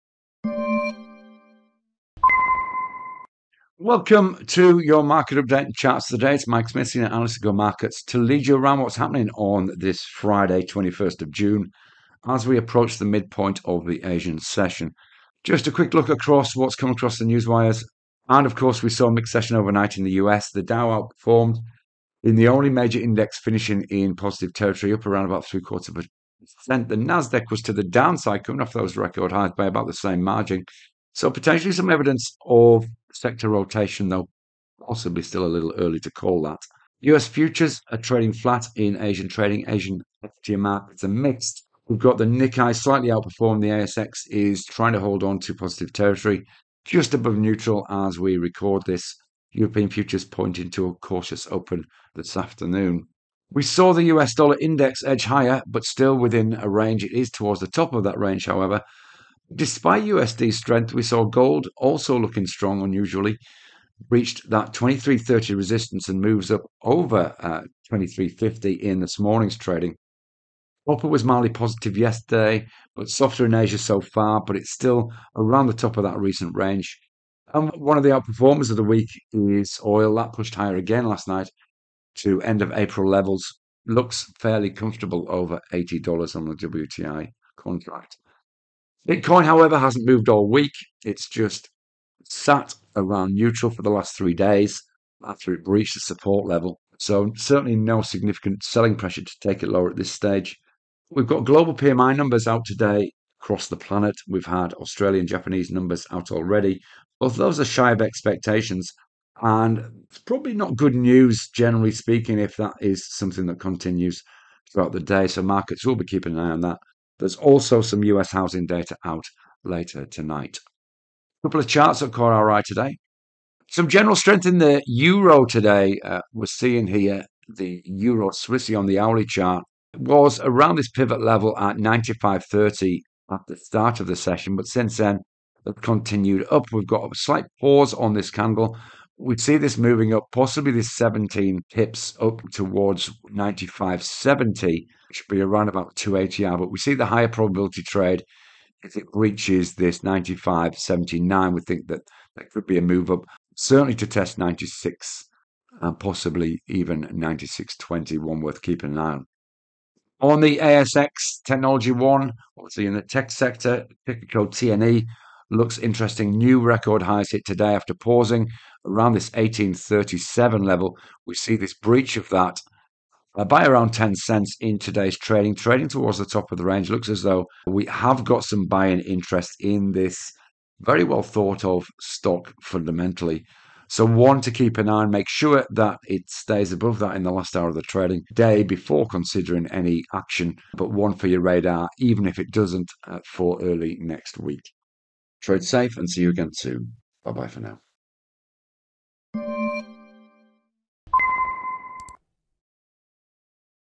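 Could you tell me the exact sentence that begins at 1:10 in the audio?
Copper was mildly positive yesterday, but softer in Asia so far, but it's still around the top of that recent range.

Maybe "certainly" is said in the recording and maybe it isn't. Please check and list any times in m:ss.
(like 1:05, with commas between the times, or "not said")
1:37, 2:33.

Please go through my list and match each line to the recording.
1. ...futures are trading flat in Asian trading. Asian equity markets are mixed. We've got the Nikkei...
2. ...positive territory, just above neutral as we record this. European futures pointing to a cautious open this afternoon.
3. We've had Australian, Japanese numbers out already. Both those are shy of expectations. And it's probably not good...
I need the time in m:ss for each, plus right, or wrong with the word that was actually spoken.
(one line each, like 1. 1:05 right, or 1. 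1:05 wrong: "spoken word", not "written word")
1. 0:37 right
2. 0:45 right
3. 1:44 right.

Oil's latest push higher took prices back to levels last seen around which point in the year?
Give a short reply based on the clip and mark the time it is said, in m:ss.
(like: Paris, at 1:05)
End of April, at 1:22.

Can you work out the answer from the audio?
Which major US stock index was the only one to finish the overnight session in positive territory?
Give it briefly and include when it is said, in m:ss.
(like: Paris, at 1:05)
The Dow, at 0:20.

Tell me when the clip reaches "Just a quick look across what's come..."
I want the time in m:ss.
0:15.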